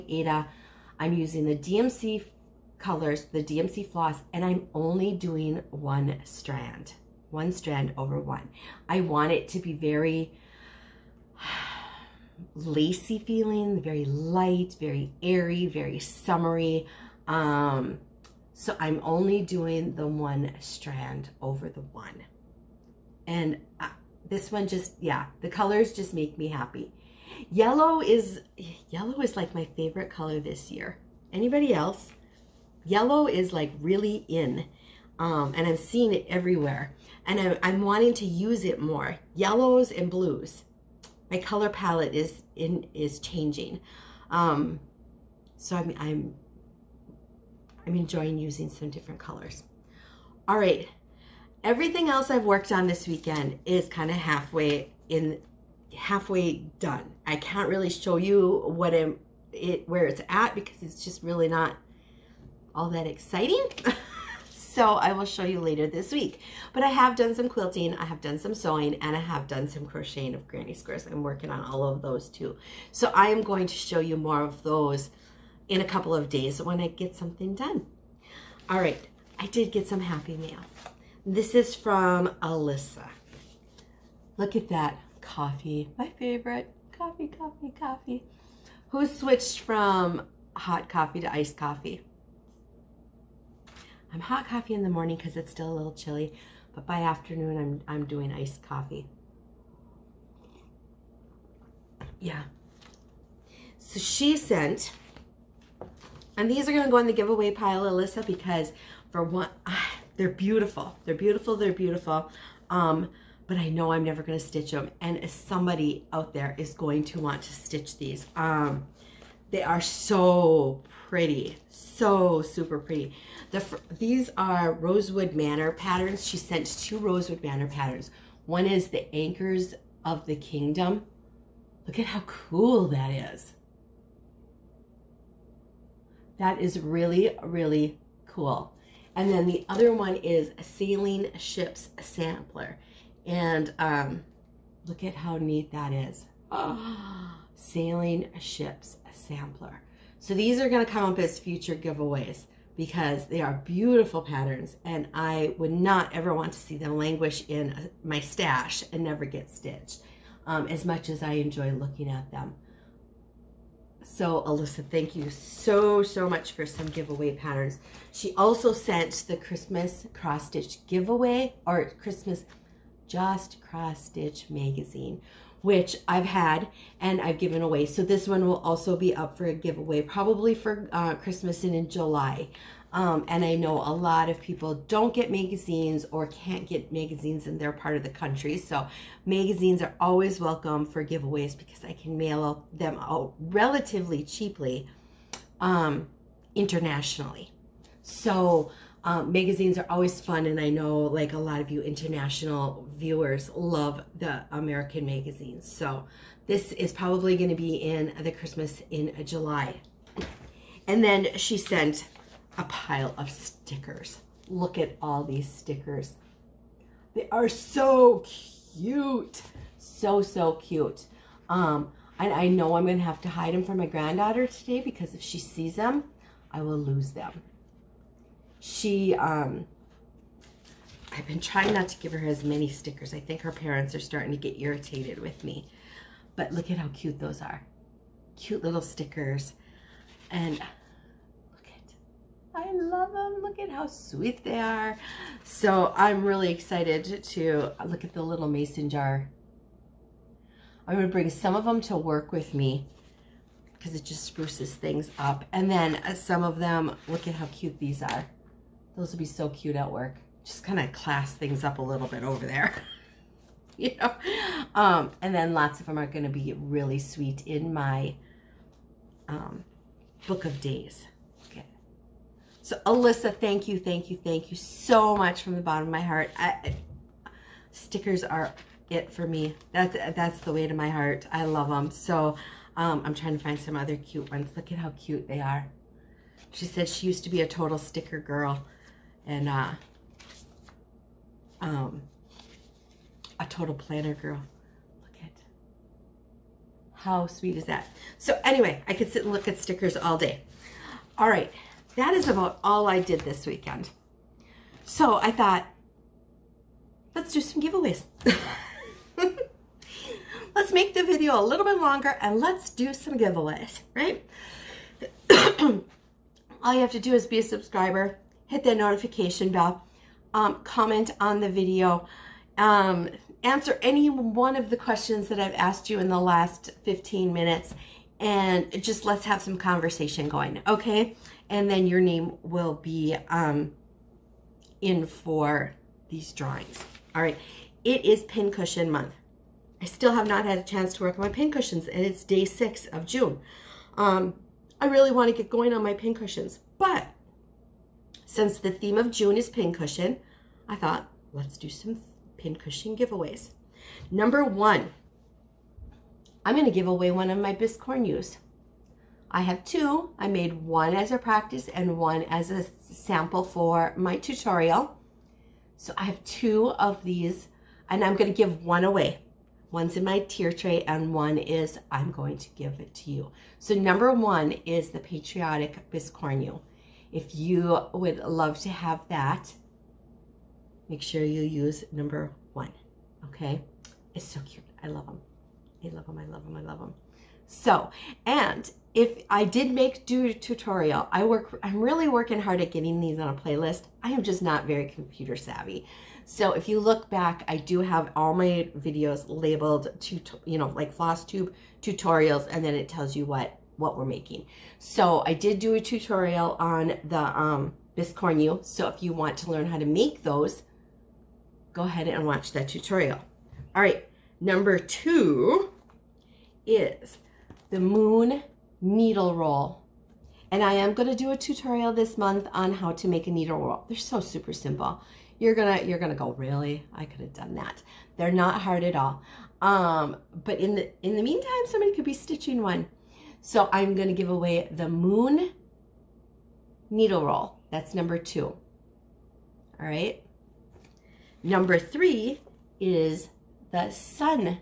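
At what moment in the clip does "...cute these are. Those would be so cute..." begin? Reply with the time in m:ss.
4:17.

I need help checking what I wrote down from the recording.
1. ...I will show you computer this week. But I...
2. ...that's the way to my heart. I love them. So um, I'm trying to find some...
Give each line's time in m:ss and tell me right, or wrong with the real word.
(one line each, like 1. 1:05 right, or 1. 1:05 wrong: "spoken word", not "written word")
1. 1:04 wrong: "later", not "computer"
2. 4:40 right.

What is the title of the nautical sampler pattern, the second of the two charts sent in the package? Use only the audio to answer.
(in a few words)
Sailing Ships Sampler.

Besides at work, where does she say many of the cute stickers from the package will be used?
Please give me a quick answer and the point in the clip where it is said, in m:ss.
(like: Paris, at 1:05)
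Book of days, at 4:30.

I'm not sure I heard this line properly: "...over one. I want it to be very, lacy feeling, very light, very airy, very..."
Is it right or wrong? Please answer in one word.
right.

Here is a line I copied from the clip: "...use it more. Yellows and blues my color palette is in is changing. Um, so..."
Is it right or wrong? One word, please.
right.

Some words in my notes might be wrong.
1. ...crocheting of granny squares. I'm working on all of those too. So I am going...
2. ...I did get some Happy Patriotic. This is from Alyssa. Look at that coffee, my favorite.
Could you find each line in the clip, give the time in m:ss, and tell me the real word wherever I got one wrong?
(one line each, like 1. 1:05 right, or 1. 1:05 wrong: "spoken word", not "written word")
1. 1:09 right
2. 1:19 wrong: "Mail", not "Patriotic".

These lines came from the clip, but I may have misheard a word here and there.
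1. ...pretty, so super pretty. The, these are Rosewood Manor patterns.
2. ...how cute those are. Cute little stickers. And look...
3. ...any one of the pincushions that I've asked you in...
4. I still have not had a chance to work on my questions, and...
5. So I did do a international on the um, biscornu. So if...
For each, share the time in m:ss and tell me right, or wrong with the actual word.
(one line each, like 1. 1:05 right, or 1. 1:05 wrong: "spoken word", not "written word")
1. 2:01 right
2. 3:56 right
3. 5:23 wrong: "questions", not "pincushions"
4. 5:39 wrong: "pincushions", not "questions"
5. 6:44 wrong: "tutorial", not "international".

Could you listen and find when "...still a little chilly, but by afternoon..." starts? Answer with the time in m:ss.
1:35.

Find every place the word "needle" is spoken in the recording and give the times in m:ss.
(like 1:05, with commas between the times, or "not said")
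6:58, 7:03, 7:16.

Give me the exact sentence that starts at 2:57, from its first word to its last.
So this one will also be up for a giveaway, probably for uh, Christmas and in July.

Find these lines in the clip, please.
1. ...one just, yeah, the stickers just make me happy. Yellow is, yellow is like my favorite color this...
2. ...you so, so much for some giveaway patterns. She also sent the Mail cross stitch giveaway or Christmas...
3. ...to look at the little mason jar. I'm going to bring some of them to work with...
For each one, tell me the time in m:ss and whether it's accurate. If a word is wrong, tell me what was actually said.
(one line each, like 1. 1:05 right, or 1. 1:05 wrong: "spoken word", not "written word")
1. 0:24 wrong: "colors", not "stickers"
2. 2:45 wrong: "Christmas", not "Mail"
3. 4:07 right.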